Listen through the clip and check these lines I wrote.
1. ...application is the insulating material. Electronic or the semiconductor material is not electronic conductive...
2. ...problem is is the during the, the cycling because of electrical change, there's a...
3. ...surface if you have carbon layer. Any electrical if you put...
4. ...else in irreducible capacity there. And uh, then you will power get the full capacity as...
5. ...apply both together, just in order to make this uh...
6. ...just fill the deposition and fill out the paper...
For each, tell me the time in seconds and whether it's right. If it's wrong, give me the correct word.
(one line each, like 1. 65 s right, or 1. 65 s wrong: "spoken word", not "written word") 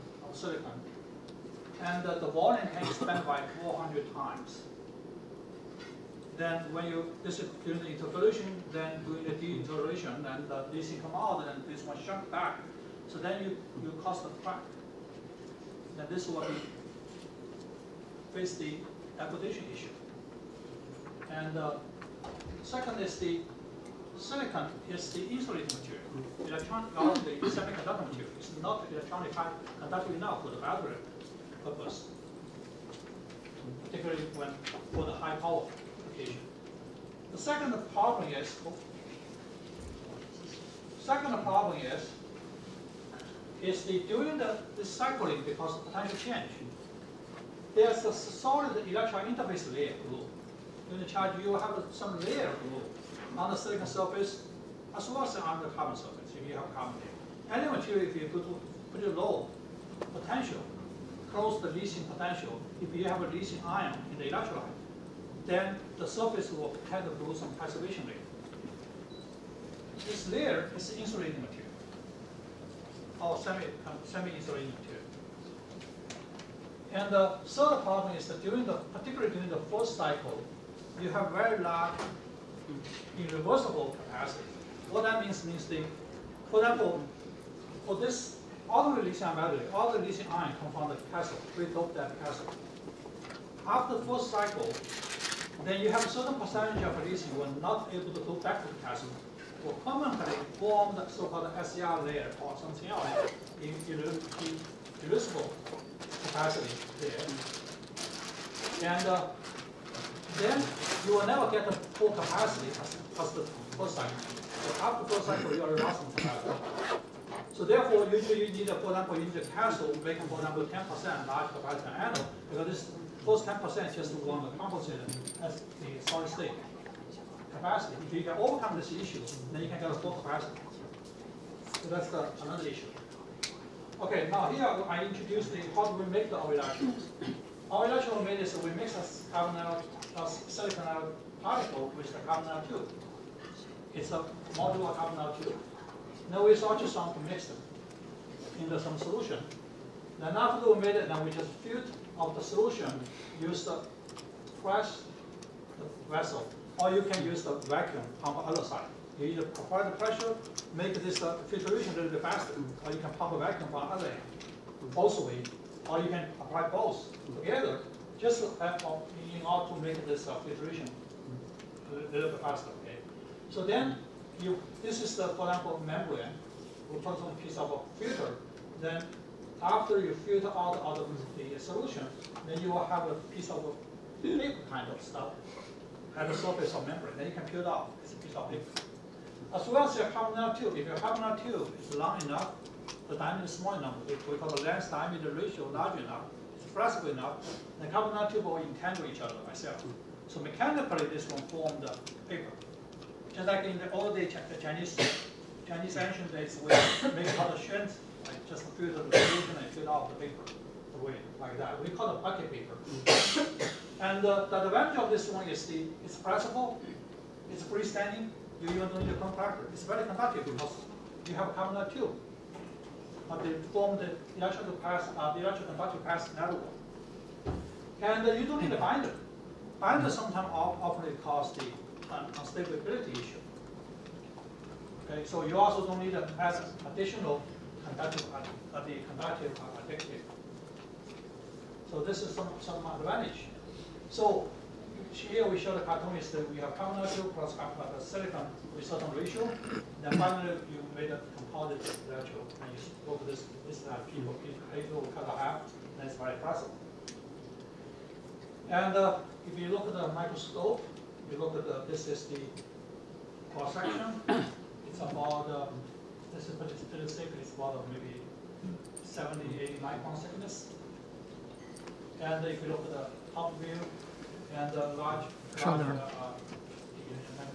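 1. 24 s wrong: "silicon", not "application"
2. 41 s wrong: "potential", not "electrical"
3. 55 s wrong: "material", not "electrical"
4. 102 s wrong: "never", not "power"
5. 166 s right
6. 208 s wrong: "solution", not "deposition".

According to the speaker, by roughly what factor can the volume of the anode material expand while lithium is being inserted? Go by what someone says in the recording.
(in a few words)
400 times.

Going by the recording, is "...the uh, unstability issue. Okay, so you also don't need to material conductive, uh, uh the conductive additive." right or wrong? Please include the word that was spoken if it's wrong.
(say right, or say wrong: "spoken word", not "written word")
wrong: "additional", not "material".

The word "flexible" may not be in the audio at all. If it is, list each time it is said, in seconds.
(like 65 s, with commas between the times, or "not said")
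196 s, 216 s.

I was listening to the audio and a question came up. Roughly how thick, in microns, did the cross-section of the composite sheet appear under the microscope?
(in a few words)
70 to 80 microns.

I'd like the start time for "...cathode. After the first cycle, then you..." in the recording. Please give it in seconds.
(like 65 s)
92 s.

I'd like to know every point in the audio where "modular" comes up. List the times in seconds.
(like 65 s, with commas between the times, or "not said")
144 s.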